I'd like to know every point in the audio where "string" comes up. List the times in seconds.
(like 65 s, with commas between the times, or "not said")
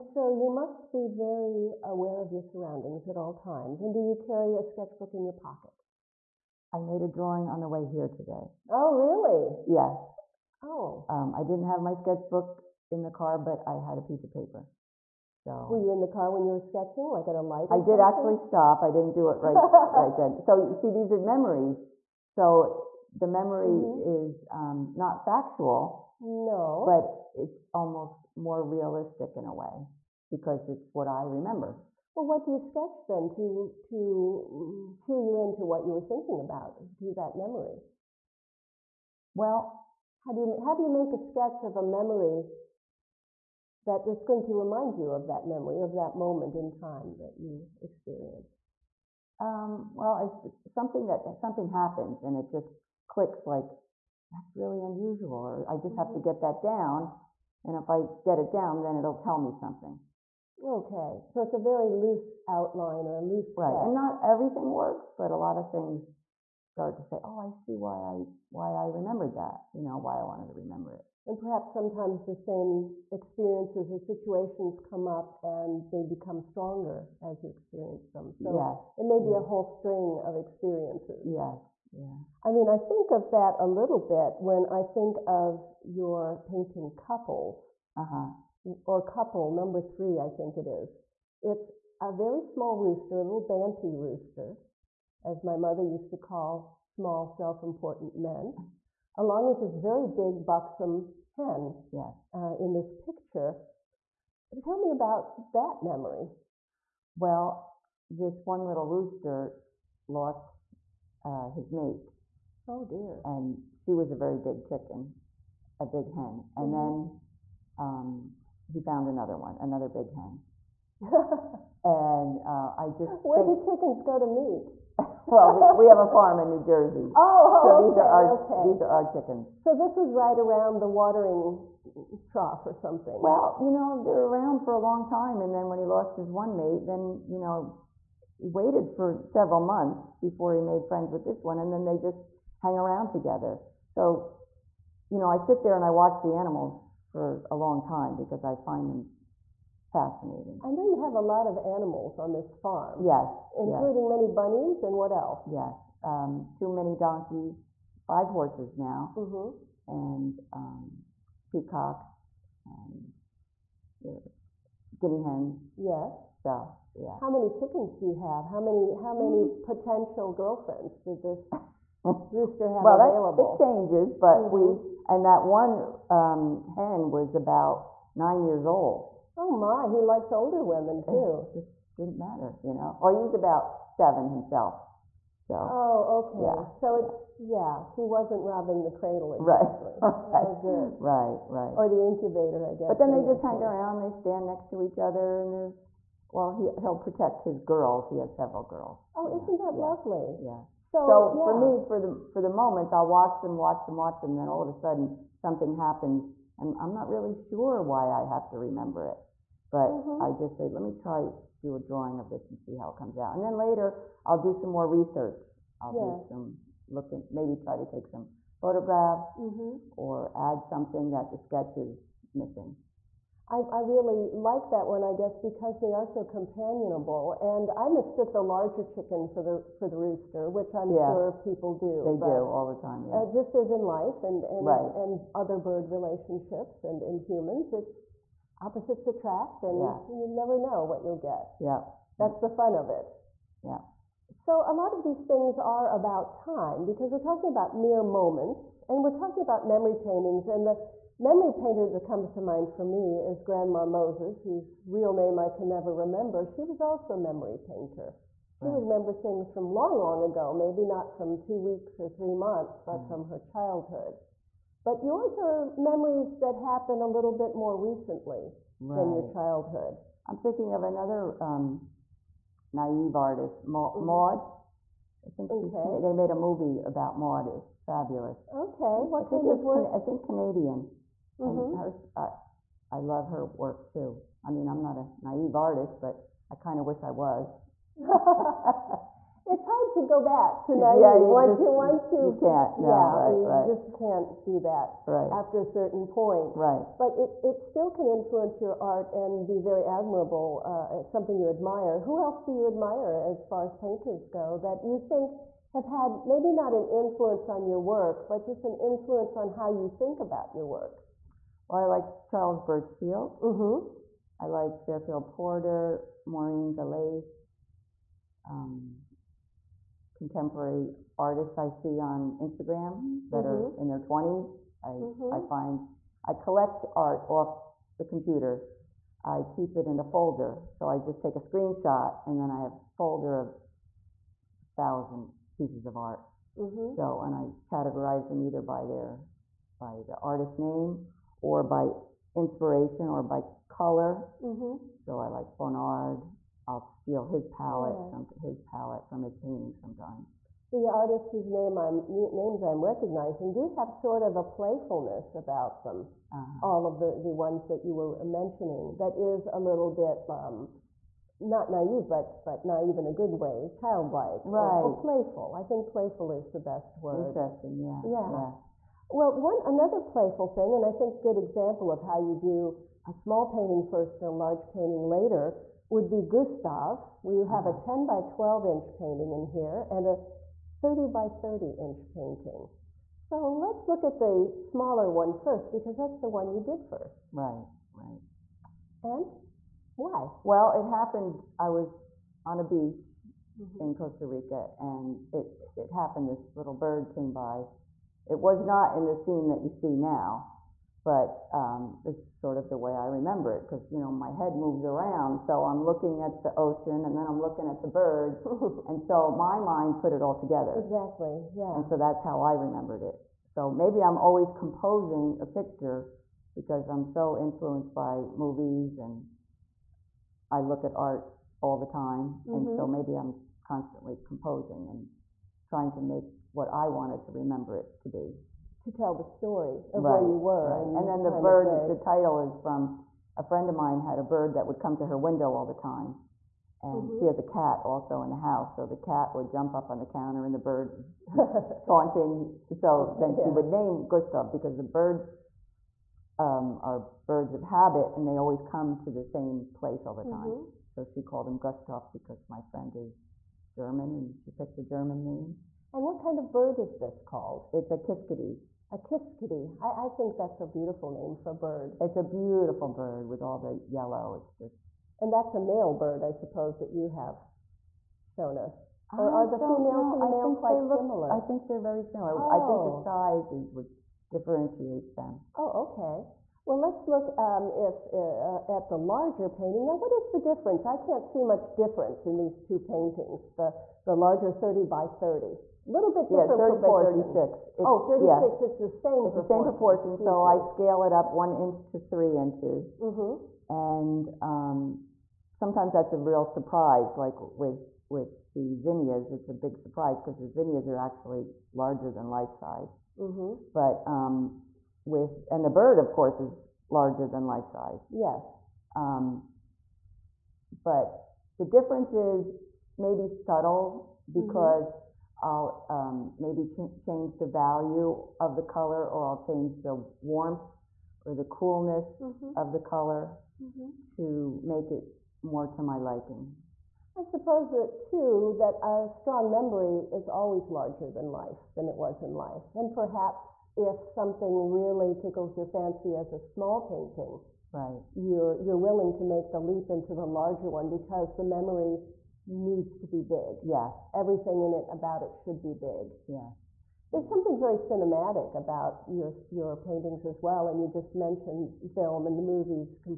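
79 s.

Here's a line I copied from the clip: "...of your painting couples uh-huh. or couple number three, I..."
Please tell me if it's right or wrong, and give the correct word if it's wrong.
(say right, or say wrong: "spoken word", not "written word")
right.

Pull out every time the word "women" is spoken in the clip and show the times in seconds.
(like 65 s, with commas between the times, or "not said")
180 s.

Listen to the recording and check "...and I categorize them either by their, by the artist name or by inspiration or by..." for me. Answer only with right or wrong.
right.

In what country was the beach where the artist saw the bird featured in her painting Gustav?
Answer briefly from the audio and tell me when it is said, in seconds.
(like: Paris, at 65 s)
Costa Rica, at 393 s.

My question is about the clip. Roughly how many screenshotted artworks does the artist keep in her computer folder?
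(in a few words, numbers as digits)
1000.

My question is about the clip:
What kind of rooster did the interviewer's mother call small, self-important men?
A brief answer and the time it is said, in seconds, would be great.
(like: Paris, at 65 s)
banty rooster, at 93 s.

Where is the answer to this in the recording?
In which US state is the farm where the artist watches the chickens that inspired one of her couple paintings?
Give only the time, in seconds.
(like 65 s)
126 s.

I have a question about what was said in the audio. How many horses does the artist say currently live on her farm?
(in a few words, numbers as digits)
5.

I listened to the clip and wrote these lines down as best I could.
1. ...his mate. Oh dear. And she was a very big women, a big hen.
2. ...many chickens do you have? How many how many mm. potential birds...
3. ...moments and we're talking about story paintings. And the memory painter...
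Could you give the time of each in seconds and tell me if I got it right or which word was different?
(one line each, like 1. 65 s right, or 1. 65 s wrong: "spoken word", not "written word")
1. 111 s wrong: "chicken", not "women"
2. 167 s wrong: "girlfriends", not "birds"
3. 248 s wrong: "memory", not "story".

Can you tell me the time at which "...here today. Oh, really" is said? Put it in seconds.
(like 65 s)
7 s.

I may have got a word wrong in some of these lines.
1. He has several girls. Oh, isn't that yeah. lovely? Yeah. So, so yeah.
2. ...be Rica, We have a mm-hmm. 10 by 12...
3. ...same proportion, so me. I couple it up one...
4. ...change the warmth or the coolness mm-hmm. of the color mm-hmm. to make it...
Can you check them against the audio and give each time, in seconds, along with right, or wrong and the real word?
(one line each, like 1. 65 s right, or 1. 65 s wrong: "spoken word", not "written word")
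1. 198 s right
2. 376 s wrong: "Gustav", not "Rica"
3. 489 s wrong: "scale", not "couple"
4. 519 s right.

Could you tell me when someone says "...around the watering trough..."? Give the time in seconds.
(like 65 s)
130 s.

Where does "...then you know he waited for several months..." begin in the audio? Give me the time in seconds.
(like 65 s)
136 s.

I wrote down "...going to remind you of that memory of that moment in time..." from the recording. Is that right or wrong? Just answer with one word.
right.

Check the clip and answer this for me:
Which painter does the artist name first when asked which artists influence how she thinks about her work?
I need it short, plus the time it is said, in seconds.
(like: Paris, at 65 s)
Charles Burchfield, at 312 s.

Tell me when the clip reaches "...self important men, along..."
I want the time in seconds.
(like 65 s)
97 s.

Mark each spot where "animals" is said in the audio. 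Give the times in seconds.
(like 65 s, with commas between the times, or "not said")
146 s, 151 s.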